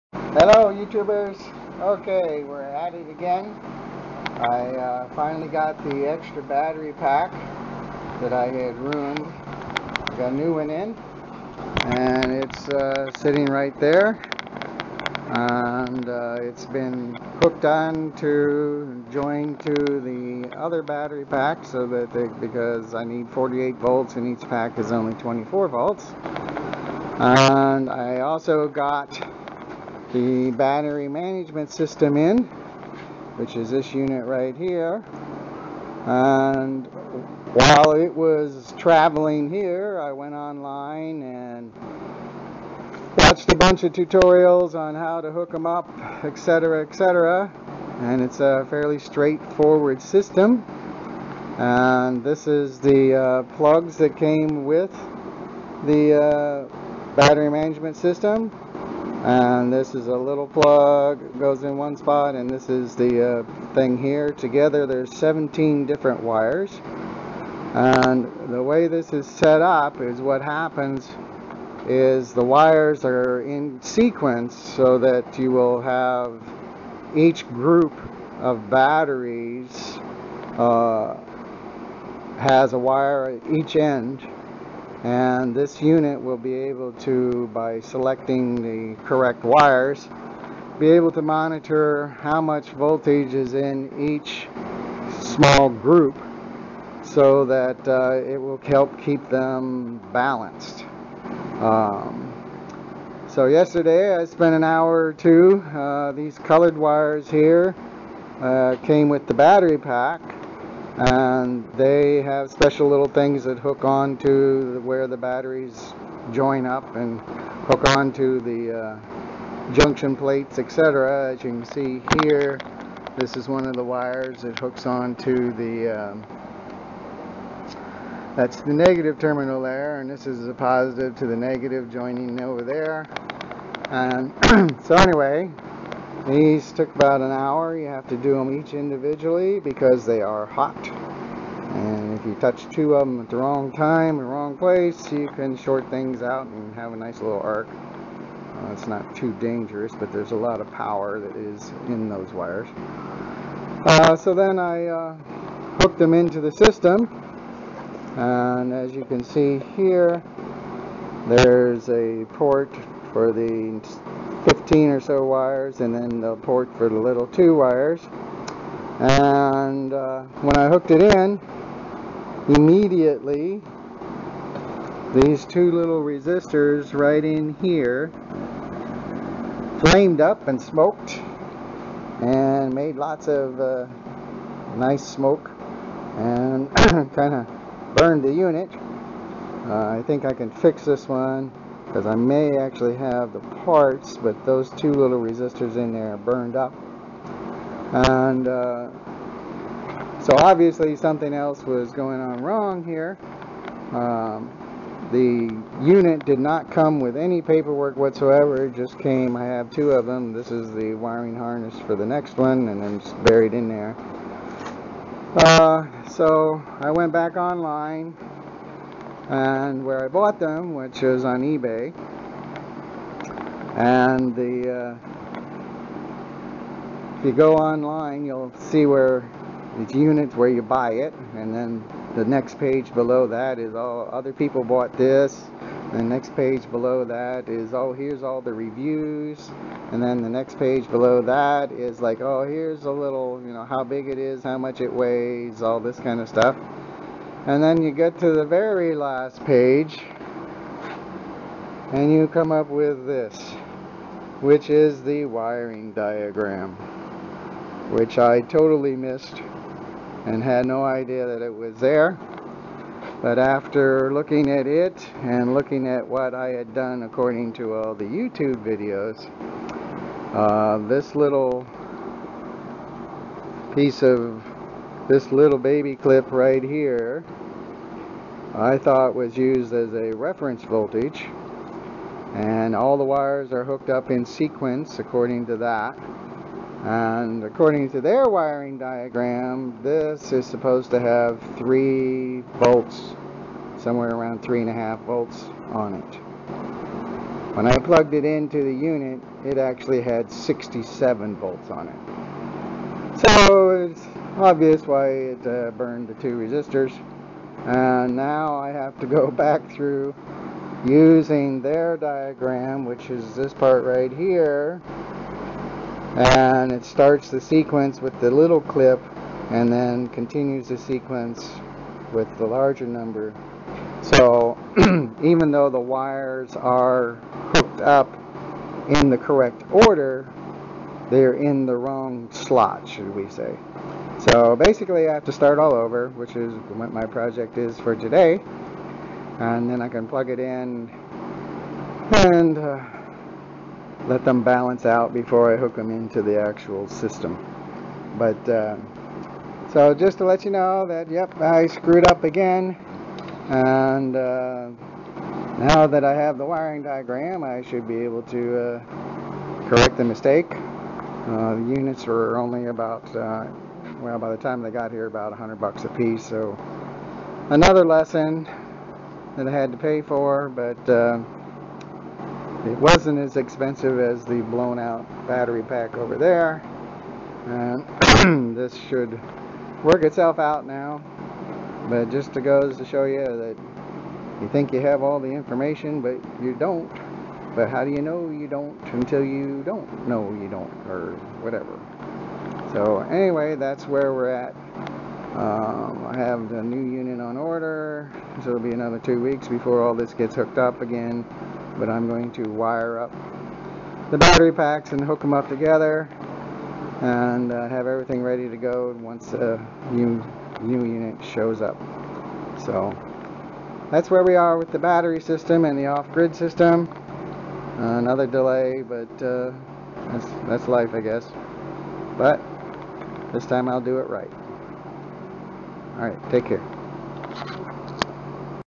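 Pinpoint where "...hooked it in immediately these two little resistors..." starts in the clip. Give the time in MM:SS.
02:50.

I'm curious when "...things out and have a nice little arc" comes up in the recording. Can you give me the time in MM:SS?
02:25.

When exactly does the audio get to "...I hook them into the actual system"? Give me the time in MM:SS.
05:45.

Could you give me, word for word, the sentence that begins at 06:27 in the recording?
But how do you know you don't until you don't know you don't, or whatever.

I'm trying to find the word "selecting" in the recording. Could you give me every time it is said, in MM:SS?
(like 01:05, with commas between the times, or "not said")
01:27.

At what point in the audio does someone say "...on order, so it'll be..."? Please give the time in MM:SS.
06:37.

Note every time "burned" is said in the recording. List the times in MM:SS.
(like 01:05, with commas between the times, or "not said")
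03:07, 03:16, 05:05.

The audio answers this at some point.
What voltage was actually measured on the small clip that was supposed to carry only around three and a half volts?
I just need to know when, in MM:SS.
05:00.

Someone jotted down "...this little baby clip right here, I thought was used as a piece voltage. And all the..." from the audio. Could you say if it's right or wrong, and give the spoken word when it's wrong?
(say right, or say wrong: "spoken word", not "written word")
wrong: "reference", not "piece".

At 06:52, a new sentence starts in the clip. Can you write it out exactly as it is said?
So that's where we are with the battery system and the off-grid system.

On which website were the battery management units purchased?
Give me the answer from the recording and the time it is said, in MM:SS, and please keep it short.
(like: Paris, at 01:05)
eBay, at 03:41.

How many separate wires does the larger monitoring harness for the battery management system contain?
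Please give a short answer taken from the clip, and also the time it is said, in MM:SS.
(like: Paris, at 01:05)
17, at 01:05.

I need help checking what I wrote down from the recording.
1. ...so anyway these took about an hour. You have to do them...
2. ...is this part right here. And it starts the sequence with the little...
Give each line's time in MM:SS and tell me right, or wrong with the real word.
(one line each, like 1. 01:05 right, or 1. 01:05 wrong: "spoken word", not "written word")
1. 02:14 right
2. 05:13 right.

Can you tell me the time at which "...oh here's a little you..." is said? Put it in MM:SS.
04:02.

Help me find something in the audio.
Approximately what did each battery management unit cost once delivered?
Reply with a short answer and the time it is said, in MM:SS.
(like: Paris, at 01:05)
$100, at 06:05.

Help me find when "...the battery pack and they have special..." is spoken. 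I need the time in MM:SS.
01:49.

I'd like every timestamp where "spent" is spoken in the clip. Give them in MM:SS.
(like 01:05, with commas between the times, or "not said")
01:44.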